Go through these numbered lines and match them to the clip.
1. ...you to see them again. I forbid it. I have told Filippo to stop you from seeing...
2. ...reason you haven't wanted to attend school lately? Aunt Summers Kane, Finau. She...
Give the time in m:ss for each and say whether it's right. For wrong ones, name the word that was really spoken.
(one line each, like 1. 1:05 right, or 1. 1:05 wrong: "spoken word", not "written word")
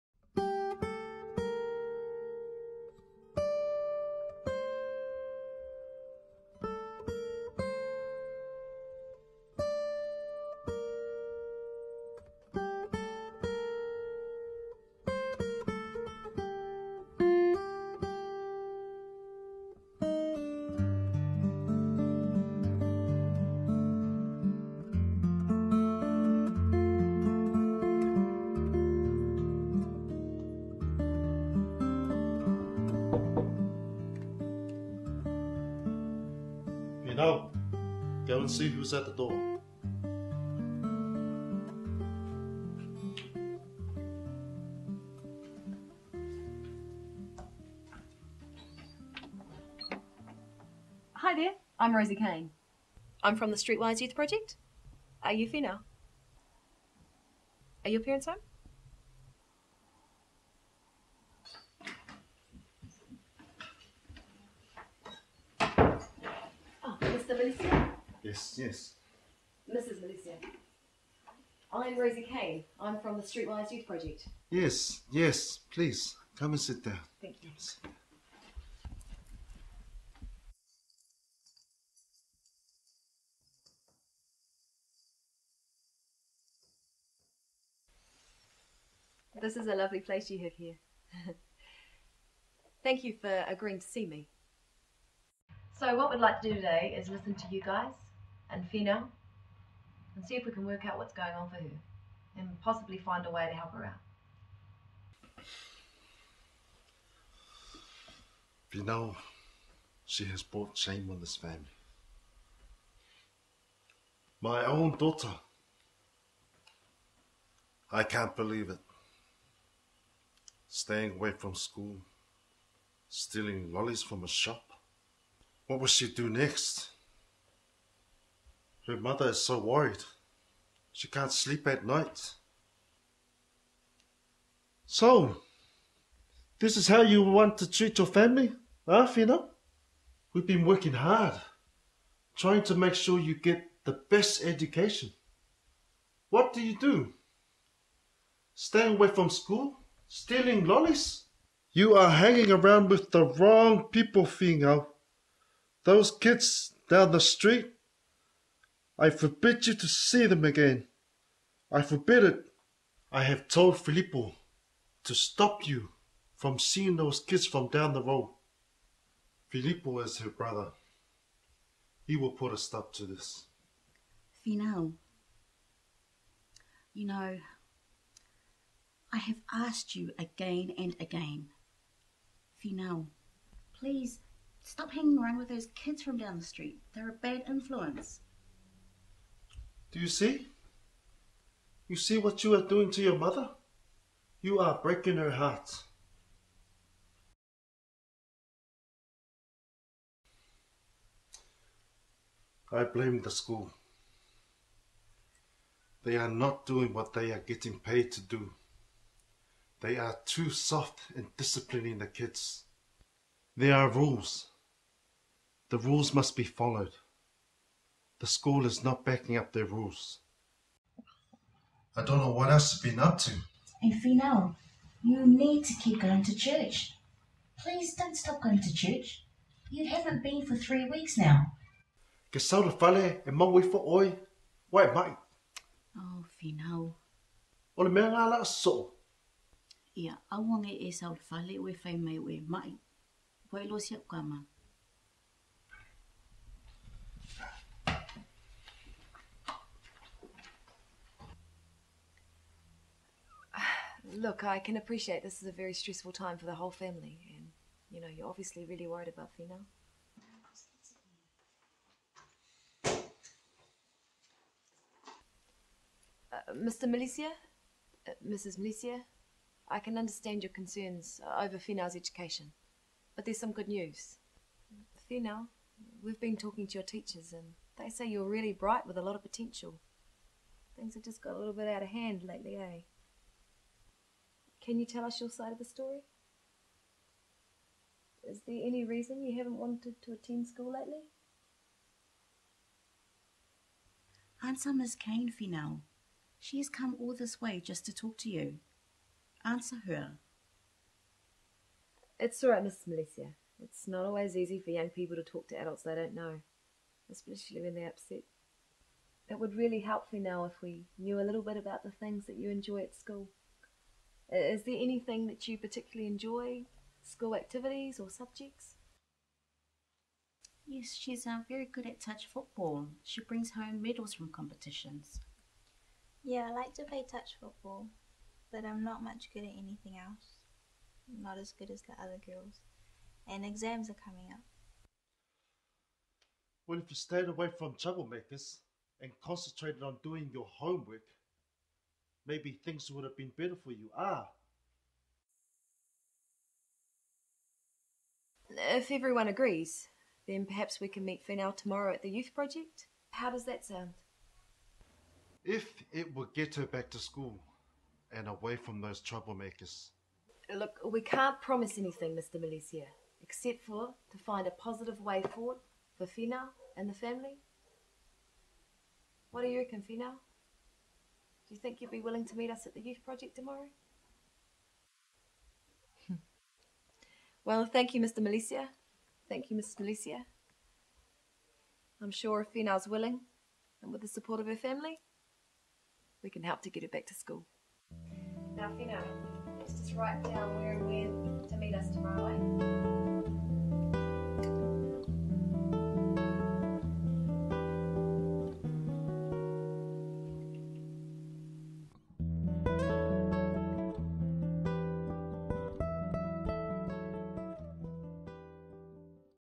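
1. 2:39 right
2. 4:48 right.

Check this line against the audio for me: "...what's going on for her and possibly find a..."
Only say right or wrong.
right.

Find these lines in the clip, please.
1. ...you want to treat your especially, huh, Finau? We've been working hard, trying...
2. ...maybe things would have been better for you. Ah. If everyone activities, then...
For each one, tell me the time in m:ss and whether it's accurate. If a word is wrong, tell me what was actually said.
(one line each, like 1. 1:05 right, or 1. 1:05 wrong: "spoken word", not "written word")
1. 2:17 wrong: "family", not "especially"
2. 5:42 wrong: "agrees", not "activities".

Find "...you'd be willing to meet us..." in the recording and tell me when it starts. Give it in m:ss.
6:11.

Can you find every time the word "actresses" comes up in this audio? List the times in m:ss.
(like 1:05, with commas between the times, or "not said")
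not said.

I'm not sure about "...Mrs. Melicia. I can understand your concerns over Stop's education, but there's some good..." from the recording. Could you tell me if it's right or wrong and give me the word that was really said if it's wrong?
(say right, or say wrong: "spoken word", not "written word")
wrong: "Finau", not "Stop".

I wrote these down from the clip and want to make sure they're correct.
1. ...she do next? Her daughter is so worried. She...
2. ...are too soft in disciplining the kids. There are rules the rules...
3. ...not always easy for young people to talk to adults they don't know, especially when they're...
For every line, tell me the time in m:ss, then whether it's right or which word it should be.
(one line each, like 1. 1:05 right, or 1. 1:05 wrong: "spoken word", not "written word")
1. 2:05 wrong: "mother", not "daughter"
2. 3:29 right
3. 5:03 right.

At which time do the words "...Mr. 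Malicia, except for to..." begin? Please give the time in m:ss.
6:02.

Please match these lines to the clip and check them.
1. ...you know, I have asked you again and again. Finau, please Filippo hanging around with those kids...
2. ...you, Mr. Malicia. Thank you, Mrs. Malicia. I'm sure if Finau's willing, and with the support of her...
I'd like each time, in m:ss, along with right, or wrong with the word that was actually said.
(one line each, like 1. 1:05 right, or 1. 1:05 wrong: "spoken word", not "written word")
1. 2:56 wrong: "Stop", not "Filippo"
2. 6:17 right.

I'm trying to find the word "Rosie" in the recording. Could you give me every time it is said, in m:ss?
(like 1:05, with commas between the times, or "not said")
0:51, 1:11.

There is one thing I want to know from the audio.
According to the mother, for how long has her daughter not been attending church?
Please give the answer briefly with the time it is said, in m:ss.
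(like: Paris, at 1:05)
three weeks, at 3:50.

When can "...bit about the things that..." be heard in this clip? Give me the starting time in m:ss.
5:11.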